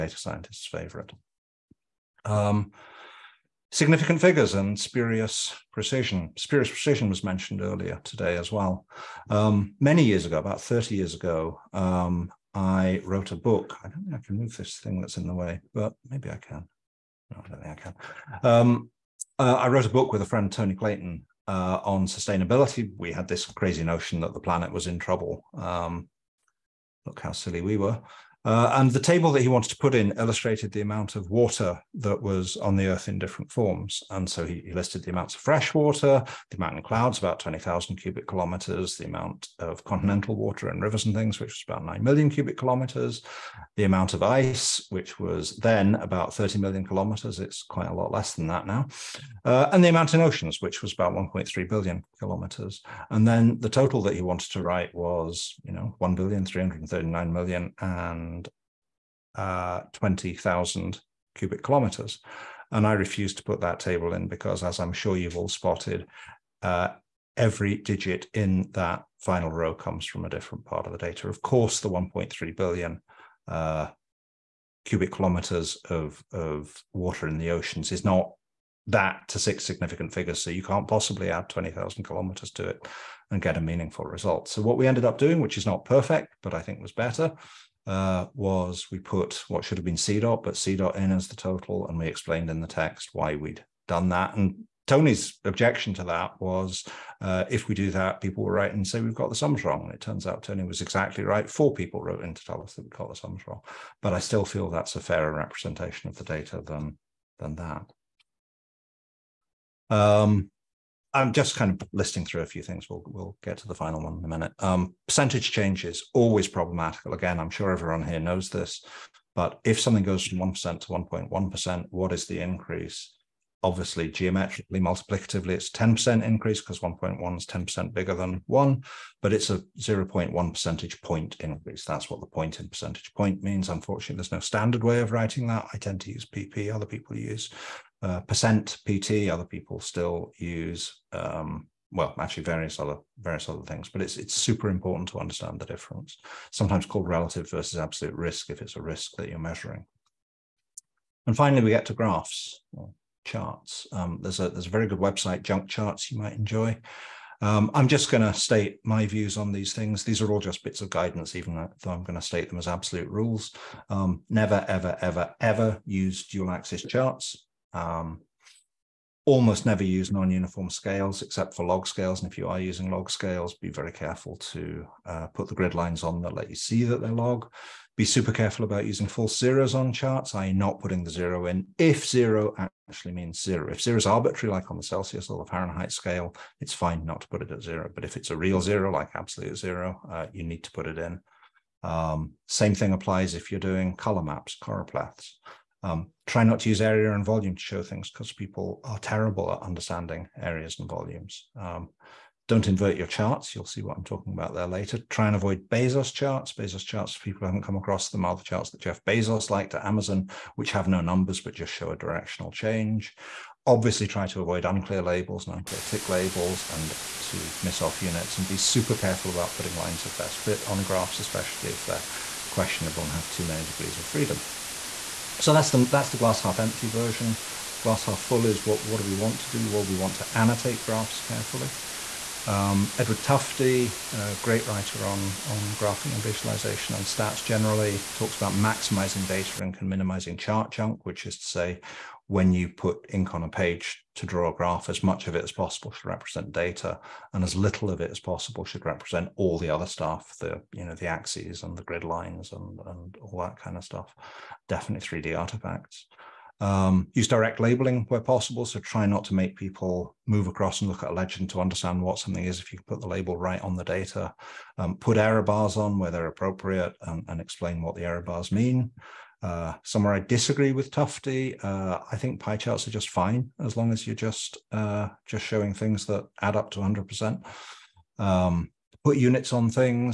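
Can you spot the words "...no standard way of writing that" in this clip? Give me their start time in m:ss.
2:14.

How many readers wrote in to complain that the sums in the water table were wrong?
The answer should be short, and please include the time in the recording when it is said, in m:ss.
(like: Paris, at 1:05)
4, at 1:41.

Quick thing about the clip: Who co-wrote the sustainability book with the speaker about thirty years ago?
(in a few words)
Tony Clayton.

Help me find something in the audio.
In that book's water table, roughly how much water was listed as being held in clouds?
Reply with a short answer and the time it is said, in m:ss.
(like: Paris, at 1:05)
20,000 cubic kilometers, at 0:37.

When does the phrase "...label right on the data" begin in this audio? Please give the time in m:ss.
4:23.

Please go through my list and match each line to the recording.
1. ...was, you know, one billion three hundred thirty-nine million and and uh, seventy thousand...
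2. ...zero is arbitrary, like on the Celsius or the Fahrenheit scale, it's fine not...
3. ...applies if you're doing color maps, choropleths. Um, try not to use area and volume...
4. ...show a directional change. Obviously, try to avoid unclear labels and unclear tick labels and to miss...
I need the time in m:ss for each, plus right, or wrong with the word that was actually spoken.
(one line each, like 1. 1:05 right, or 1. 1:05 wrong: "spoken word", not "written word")
1. 0:54 wrong: "twenty", not "seventy"
2. 3:03 right
3. 3:12 right
4. 3:31 right.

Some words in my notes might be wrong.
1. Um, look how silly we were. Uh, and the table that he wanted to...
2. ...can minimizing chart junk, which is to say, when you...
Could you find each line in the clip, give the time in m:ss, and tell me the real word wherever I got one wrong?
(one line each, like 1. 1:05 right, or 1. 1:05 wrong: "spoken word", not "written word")
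1. 0:25 right
2. 3:59 right.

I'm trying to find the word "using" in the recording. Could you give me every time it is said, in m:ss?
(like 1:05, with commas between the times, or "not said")
2:52, 2:58.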